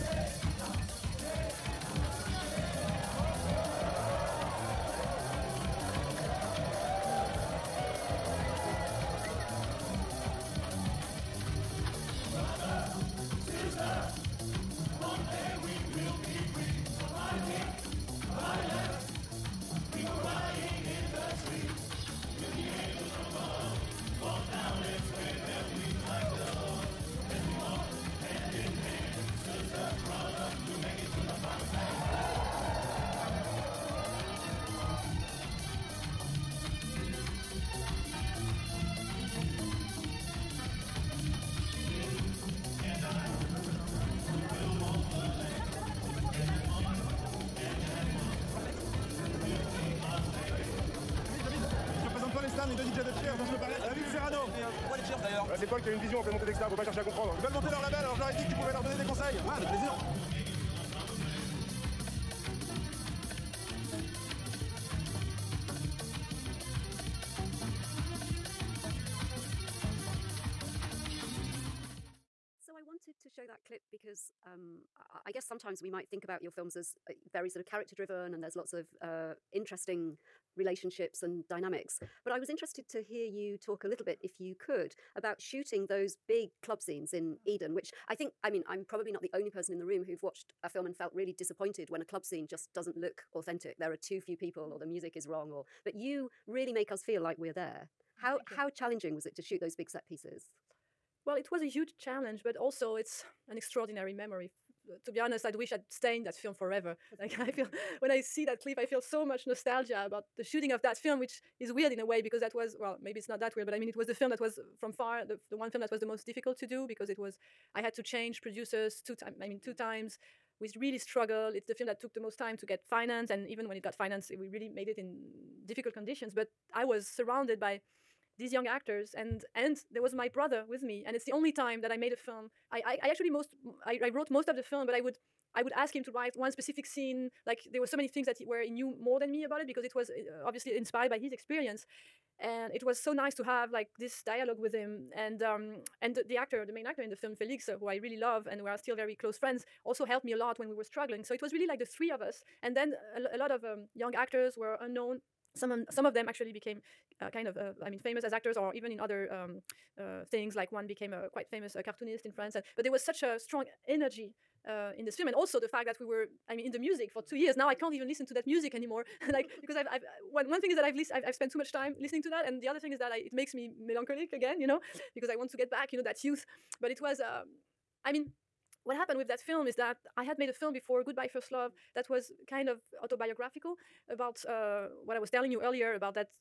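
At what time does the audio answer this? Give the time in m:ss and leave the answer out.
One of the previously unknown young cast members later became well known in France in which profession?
2:41.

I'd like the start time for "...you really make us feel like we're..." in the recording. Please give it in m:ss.
1:35.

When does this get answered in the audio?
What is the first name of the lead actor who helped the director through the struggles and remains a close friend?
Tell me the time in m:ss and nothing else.
2:27.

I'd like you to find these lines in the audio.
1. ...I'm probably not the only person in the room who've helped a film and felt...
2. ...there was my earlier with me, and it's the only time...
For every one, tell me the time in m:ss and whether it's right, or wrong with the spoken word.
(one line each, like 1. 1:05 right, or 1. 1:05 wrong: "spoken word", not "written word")
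1. 1:28 wrong: "watched", not "helped"
2. 2:09 wrong: "brother", not "earlier".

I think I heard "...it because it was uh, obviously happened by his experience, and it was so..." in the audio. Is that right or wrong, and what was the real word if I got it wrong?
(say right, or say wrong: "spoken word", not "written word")
wrong: "inspired", not "happened".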